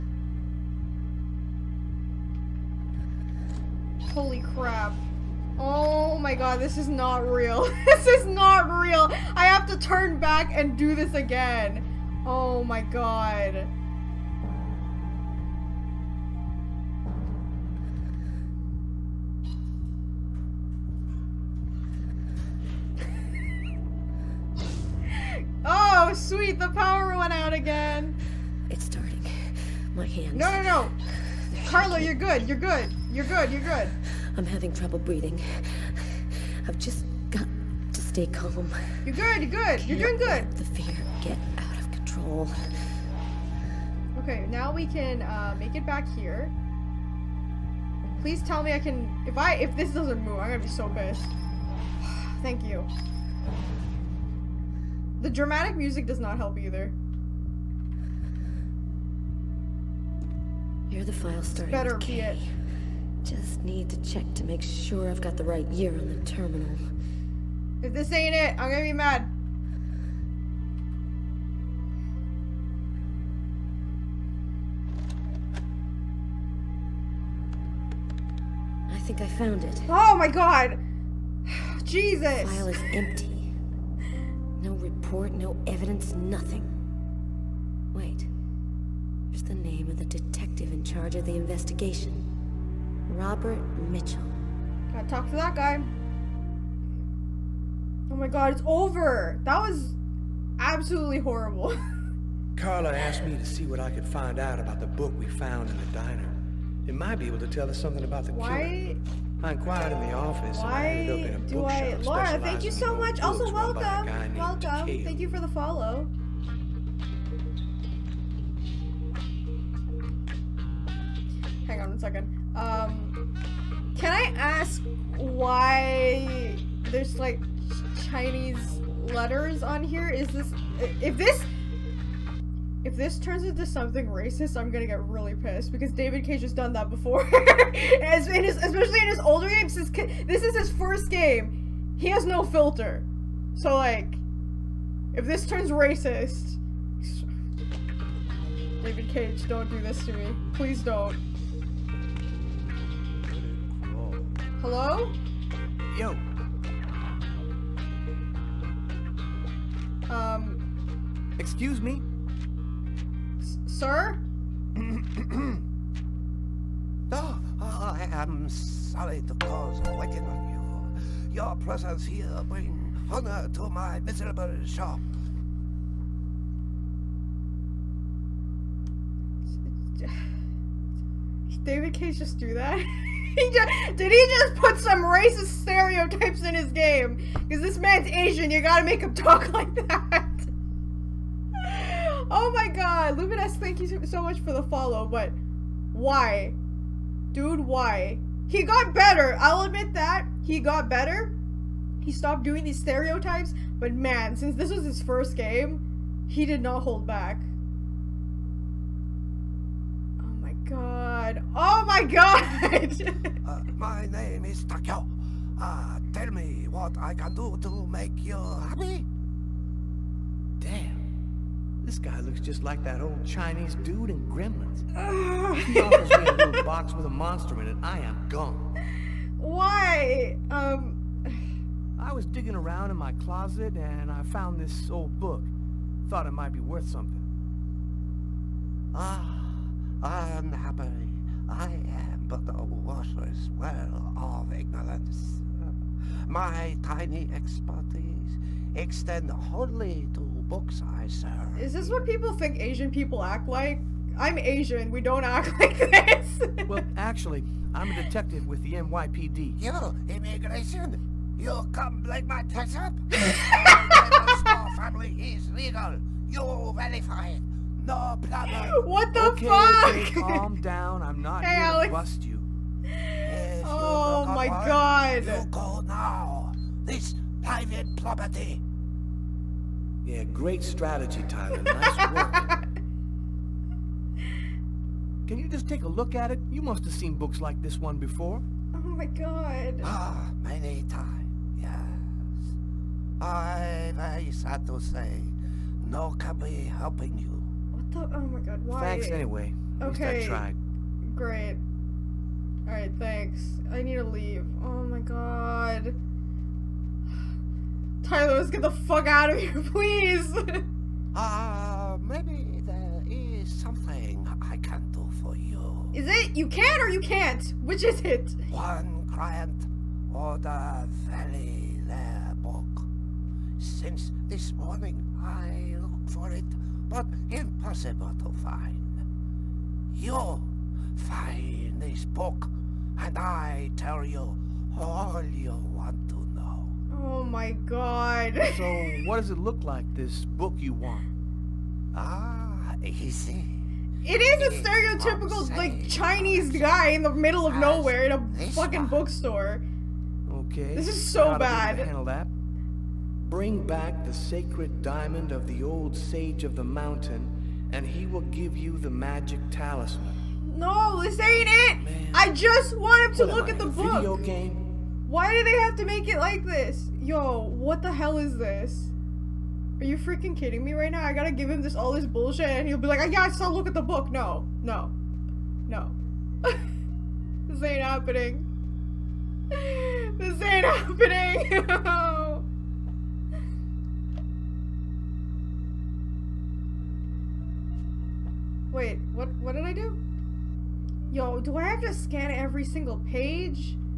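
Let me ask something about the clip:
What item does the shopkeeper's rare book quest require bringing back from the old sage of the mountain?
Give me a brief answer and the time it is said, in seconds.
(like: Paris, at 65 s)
sacred diamond, at 354 s.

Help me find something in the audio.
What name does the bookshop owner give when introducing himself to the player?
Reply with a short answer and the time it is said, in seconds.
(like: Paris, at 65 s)
Takeo, at 214 s.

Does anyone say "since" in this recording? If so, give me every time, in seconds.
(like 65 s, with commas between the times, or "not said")
139 s, 204 s, 323 s.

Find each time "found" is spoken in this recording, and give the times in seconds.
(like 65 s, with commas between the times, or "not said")
79 s, 105 s, 234 s.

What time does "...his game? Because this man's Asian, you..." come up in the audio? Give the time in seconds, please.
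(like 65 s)
186 s.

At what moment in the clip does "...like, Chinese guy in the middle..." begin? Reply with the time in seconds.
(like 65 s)
345 s.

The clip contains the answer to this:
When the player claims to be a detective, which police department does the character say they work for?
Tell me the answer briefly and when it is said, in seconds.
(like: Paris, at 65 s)
NYPD, at 258 s.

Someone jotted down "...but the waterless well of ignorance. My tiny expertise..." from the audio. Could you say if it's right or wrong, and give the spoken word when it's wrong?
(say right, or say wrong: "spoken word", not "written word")
right.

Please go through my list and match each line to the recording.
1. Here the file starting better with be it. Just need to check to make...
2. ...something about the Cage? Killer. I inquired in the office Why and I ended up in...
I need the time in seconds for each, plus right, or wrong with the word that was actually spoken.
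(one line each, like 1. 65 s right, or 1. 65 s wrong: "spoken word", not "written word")
1. 60 s right
2. 107 s wrong: "Why", not "Cage".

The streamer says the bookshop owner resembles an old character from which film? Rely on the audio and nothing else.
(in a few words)
Gremlins.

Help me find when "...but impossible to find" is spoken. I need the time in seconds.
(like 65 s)
326 s.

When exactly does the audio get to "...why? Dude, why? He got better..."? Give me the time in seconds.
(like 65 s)
195 s.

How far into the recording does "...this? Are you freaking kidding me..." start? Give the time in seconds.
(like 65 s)
368 s.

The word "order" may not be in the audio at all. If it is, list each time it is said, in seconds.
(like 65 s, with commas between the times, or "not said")
320 s.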